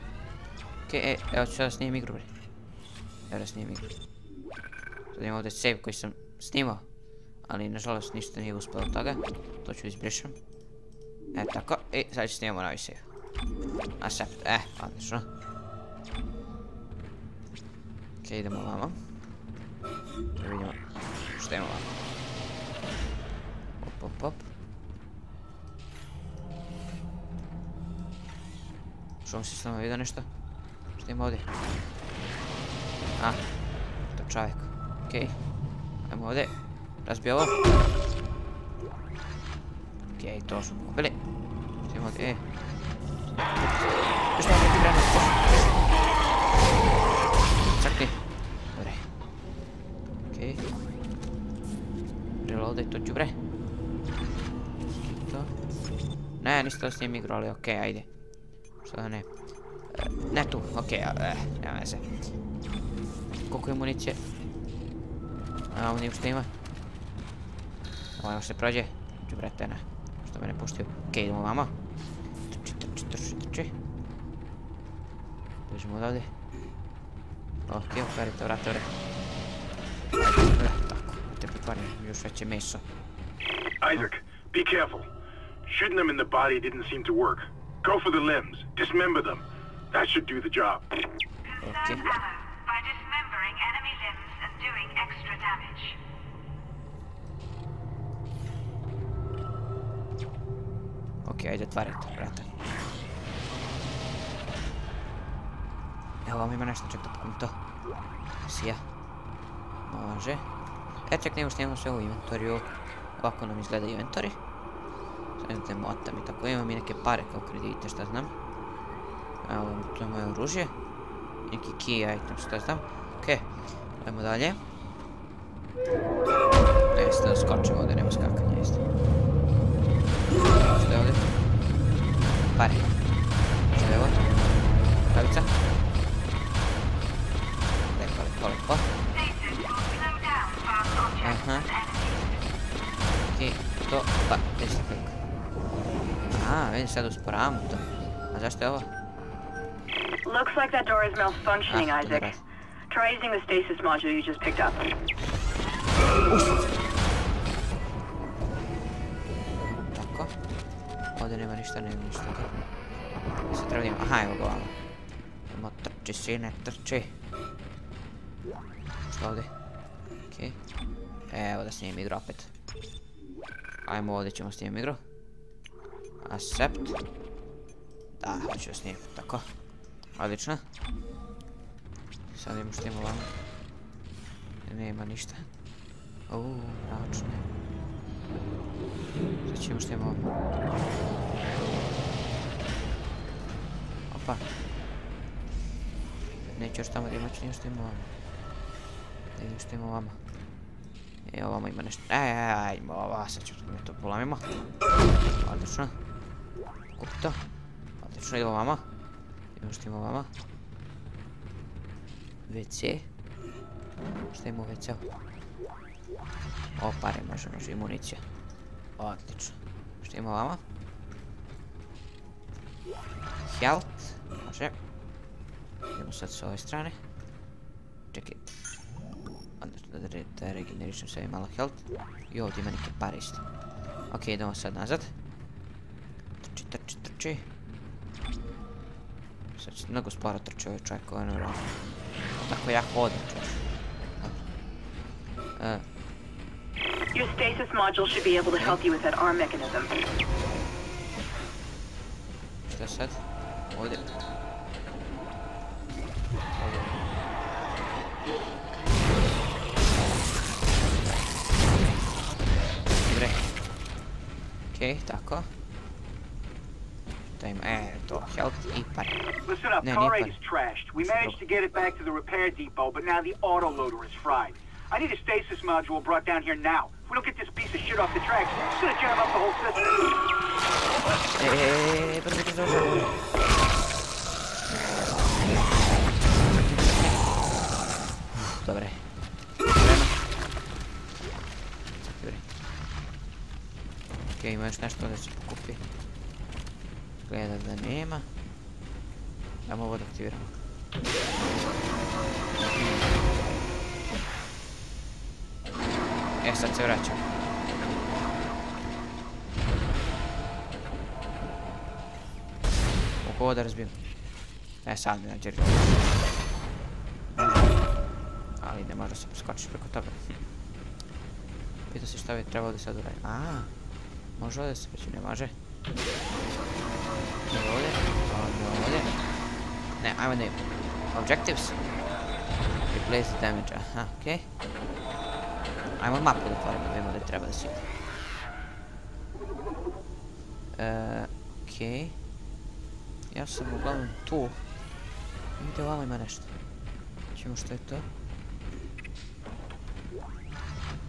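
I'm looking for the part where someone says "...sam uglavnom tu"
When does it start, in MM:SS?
05:43.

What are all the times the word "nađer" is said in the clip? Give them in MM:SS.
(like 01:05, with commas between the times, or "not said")
05:15.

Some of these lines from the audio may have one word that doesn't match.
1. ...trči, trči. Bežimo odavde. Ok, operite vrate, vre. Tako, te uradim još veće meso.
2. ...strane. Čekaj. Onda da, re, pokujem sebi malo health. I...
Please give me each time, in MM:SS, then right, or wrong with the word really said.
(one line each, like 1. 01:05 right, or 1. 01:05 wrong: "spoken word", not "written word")
1. 01:13 wrong: "pretvarim", not "uradim"
2. 03:46 wrong: "regenerišem", not "pokujem".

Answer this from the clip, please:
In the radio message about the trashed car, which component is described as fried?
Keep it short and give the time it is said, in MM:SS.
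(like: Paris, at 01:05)
autoloader, at 04:33.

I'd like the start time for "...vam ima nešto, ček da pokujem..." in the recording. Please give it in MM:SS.
01:46.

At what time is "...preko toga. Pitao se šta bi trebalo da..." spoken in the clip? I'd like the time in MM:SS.
05:19.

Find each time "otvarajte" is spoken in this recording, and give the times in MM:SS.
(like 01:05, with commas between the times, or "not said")
01:41.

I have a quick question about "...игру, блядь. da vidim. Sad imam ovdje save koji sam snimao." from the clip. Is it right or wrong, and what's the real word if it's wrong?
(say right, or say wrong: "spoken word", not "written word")
wrong: "snimim", not "vidim".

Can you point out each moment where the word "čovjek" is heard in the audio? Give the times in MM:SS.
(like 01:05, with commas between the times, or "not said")
00:34, 04:00.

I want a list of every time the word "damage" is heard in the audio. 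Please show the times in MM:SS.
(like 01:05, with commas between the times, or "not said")
01:35, 05:33.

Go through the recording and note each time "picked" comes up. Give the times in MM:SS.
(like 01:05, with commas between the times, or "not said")
02:34.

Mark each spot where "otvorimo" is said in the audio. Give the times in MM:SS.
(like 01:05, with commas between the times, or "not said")
05:36.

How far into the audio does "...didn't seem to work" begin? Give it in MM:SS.
01:26.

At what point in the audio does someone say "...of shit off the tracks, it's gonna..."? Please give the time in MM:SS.
04:37.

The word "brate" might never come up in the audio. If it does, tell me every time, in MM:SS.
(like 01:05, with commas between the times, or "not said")
01:09, 01:42.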